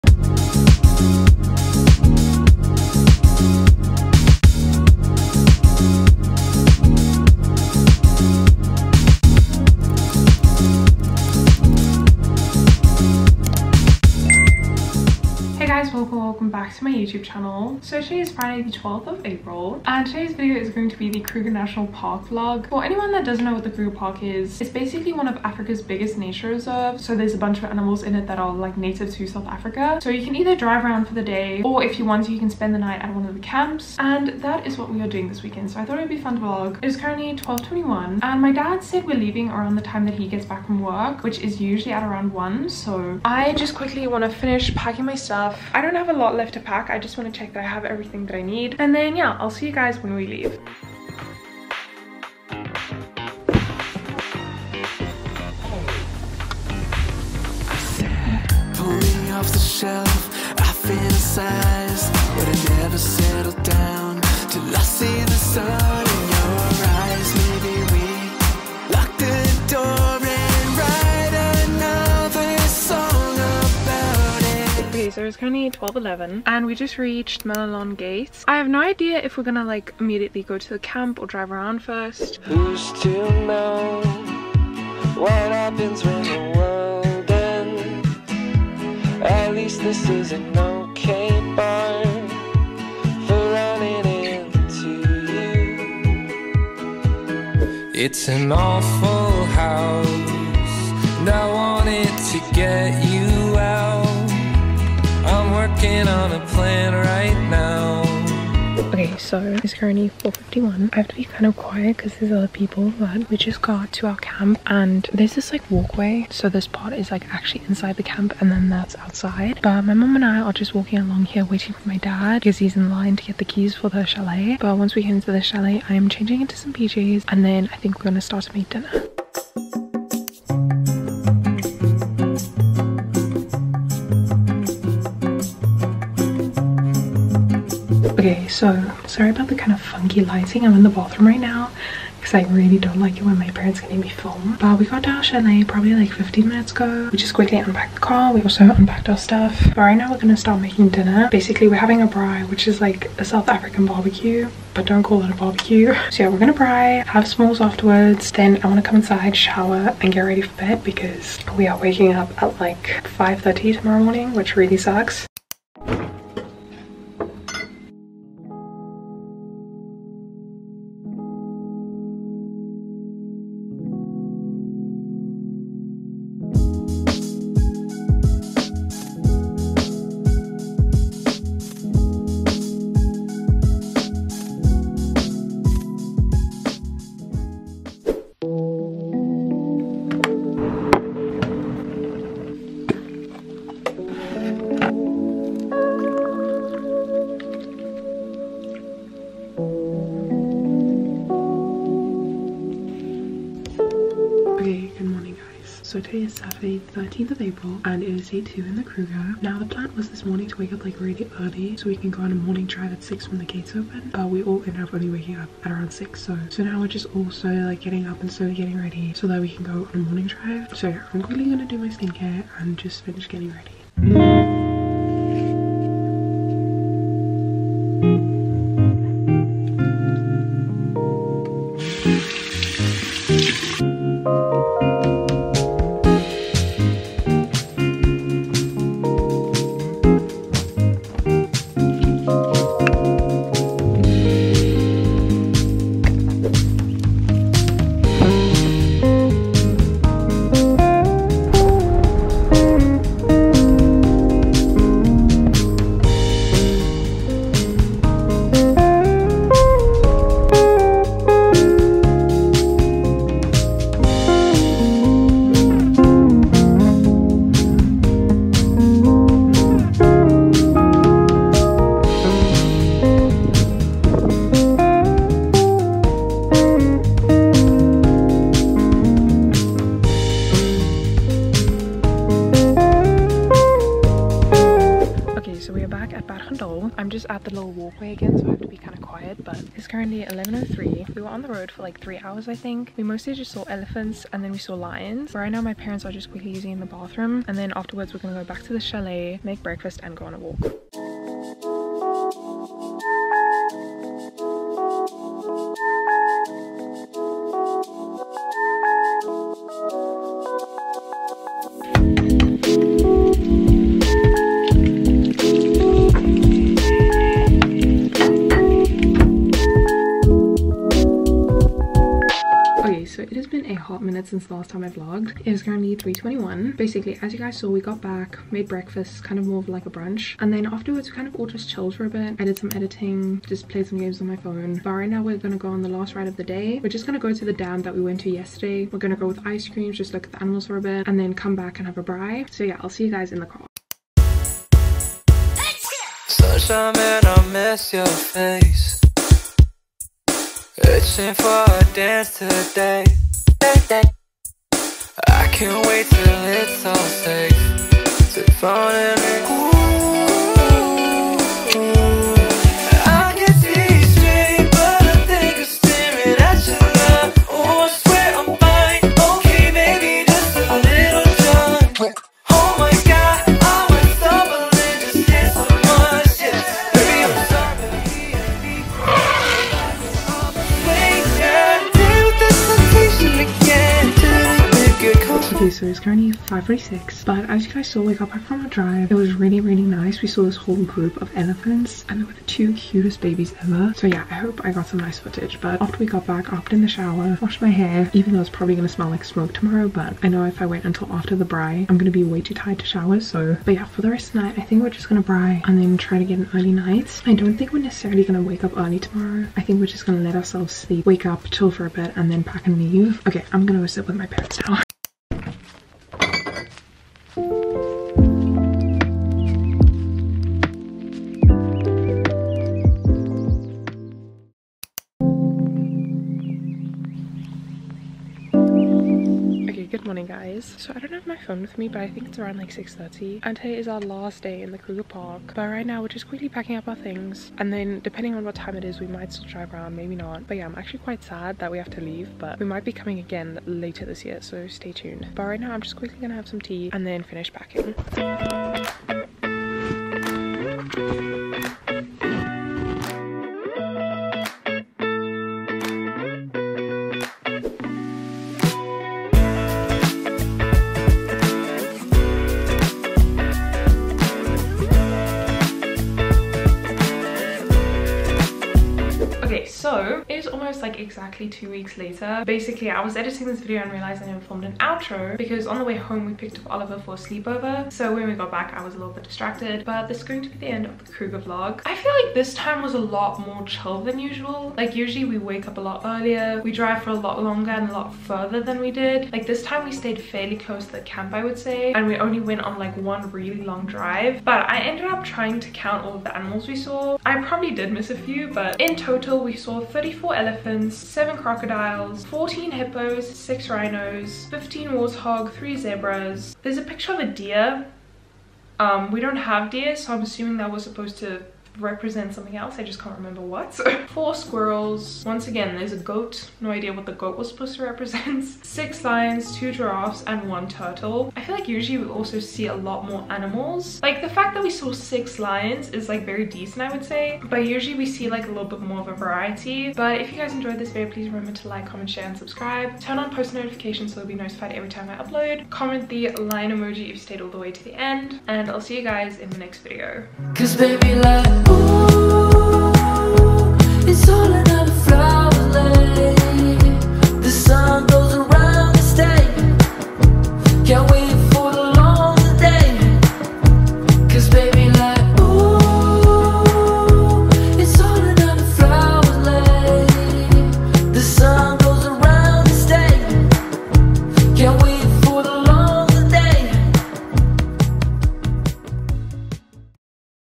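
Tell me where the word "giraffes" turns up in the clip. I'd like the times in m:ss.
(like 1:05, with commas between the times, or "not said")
8:39.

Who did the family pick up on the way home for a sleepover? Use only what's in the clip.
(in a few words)
Oliver.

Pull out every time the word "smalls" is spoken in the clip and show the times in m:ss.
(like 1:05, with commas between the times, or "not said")
2:37.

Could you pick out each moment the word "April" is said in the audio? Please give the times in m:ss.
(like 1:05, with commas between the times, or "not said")
0:19, 3:27.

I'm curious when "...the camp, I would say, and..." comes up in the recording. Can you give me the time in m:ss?
8:10.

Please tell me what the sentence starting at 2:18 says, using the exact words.
so sorry about the kind of funky lighting.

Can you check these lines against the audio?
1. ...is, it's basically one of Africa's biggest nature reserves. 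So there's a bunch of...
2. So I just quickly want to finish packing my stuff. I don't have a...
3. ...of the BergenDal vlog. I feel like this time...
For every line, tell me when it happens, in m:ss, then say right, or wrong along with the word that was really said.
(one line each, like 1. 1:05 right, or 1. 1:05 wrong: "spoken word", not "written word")
1. 0:24 right
2. 0:42 right
3. 8:00 wrong: "Kruger", not "BergenDal".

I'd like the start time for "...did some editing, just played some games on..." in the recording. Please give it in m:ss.
5:32.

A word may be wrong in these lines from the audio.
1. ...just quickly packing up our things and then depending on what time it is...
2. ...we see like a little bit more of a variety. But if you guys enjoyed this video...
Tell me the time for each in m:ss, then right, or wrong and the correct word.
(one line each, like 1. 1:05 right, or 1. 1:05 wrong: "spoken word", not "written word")
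1. 7:16 right
2. 8:47 right.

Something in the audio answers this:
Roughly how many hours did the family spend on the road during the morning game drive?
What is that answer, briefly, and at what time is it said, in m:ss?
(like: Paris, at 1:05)
3 hours, at 4:52.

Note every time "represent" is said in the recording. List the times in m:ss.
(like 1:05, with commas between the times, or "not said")
8:31, 8:37.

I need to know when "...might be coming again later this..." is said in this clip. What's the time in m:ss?
7:22.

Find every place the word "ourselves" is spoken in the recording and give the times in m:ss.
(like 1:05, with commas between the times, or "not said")
6:50.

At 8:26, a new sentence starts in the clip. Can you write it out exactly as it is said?
There's a picture of a deer.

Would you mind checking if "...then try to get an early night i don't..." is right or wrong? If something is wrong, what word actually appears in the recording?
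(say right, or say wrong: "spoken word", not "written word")
right.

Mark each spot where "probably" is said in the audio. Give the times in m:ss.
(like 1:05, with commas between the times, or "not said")
2:25, 6:38, 8:17.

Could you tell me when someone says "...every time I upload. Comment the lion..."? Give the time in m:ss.
8:54.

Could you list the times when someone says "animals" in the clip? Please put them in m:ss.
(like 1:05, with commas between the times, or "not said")
0:27, 5:40, 8:16, 8:43.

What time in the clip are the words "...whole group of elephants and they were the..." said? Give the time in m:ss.
6:30.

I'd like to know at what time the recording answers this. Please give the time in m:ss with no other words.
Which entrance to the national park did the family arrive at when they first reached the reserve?
1:17.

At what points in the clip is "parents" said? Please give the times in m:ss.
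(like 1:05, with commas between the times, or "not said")
2:23, 4:55, 6:54.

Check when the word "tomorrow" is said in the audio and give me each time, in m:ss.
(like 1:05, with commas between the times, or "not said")
2:43, 6:39, 6:48.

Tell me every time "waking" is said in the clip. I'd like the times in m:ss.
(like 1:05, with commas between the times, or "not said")
2:41, 3:35.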